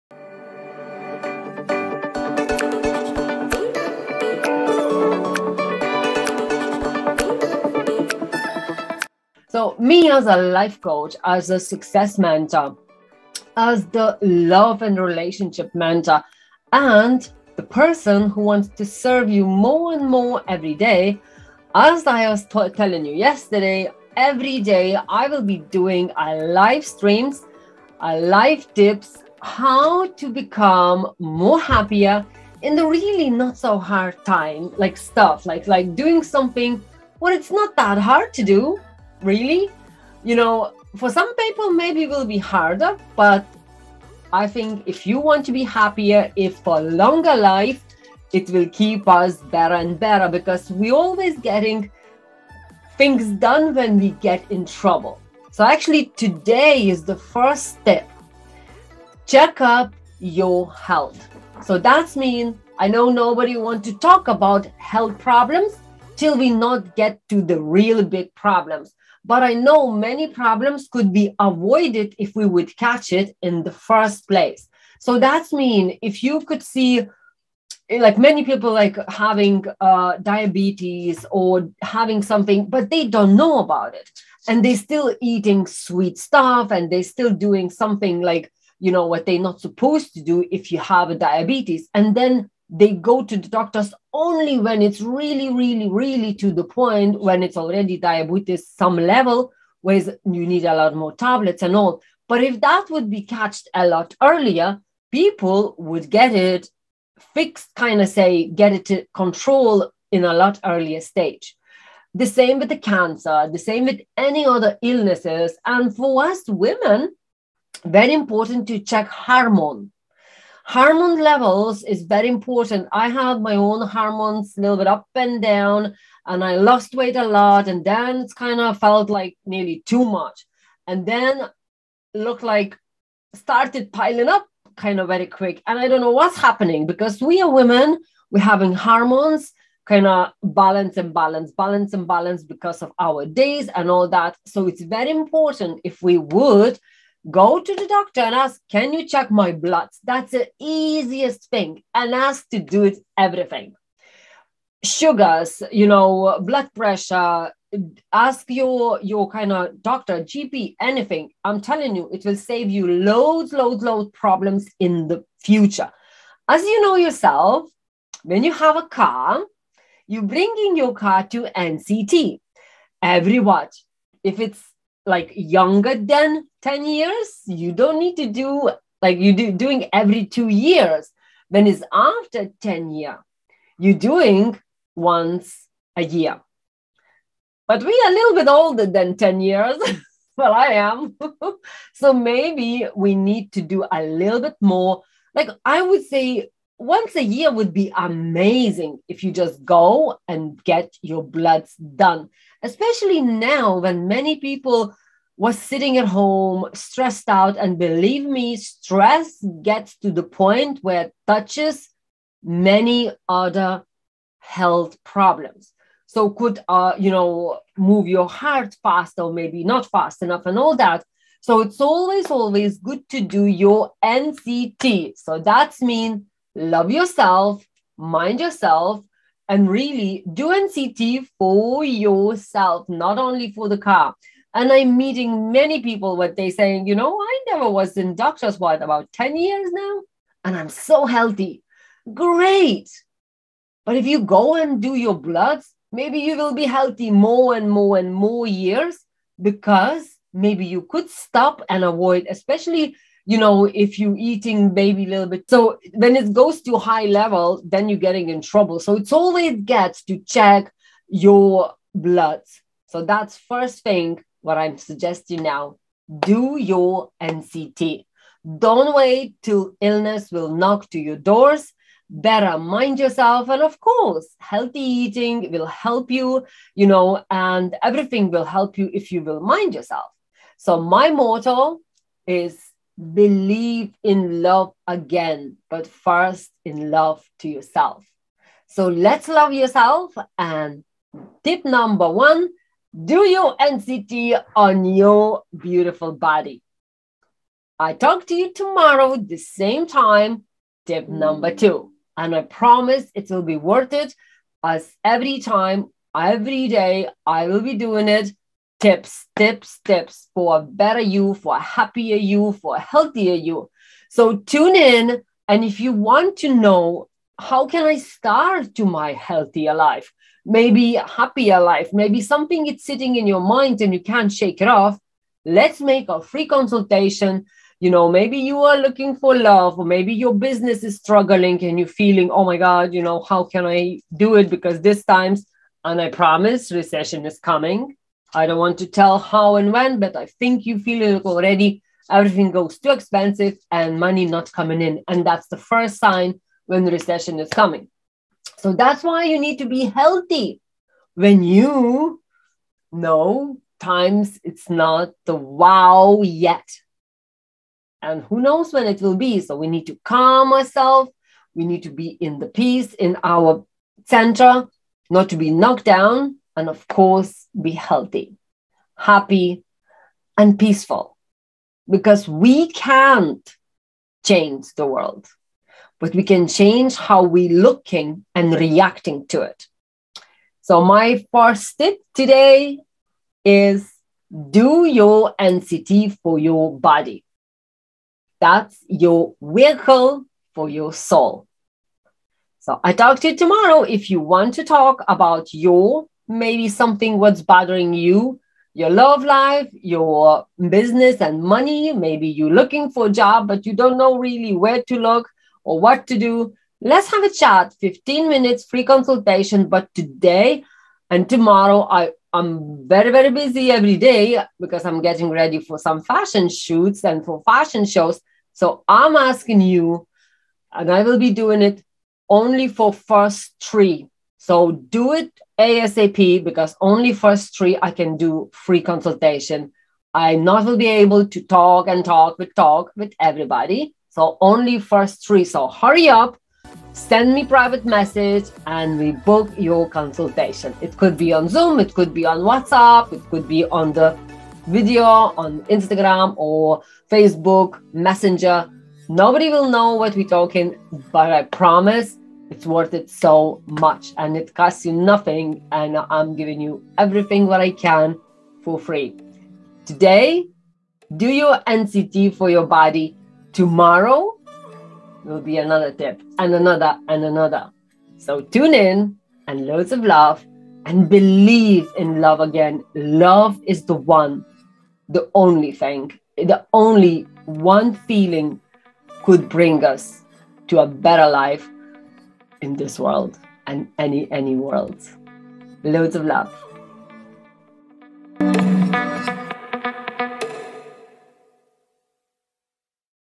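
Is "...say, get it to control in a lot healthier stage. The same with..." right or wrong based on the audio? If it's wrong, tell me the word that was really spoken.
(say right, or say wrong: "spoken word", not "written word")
wrong: "earlier", not "healthier".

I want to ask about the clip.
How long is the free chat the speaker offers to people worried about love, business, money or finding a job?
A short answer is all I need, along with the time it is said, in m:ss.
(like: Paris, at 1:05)
15 minutes, at 6:47.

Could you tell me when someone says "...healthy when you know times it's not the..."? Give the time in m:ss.
5:49.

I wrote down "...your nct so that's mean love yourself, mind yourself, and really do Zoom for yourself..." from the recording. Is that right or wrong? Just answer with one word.
wrong.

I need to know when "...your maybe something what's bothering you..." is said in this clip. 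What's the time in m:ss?
6:35.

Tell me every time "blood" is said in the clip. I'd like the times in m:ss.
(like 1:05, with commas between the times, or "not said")
2:29, 2:36, 3:21, 4:05, 4:21.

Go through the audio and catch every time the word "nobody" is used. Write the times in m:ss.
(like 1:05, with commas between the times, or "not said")
1:03, 7:29.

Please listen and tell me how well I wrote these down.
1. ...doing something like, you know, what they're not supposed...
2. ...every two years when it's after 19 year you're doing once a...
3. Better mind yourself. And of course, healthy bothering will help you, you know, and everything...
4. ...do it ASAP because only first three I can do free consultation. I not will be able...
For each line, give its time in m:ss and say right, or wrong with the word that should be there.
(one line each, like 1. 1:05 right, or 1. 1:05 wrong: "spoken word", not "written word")
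1. 1:27 right
2. 2:59 wrong: "10", not "19"
3. 4:32 wrong: "eating", not "bothering"
4. 7:04 right.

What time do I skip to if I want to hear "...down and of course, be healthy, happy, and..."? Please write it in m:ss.
6:05.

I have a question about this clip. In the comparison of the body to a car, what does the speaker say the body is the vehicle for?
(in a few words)
Your soul.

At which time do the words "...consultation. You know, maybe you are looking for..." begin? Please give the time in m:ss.
5:26.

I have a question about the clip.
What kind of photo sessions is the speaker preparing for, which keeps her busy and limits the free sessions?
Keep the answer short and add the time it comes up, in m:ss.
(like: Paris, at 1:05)
Fashion shoots, at 6:56.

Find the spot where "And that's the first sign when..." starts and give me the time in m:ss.
5:45.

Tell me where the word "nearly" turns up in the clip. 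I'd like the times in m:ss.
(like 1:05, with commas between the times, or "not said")
2:09.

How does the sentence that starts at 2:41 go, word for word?
I'm telling you, it will save you loads, loads, loads problems in the future.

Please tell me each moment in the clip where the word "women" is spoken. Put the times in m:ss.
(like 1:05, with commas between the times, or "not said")
1:56, 2:17.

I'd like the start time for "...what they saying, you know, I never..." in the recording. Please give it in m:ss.
3:56.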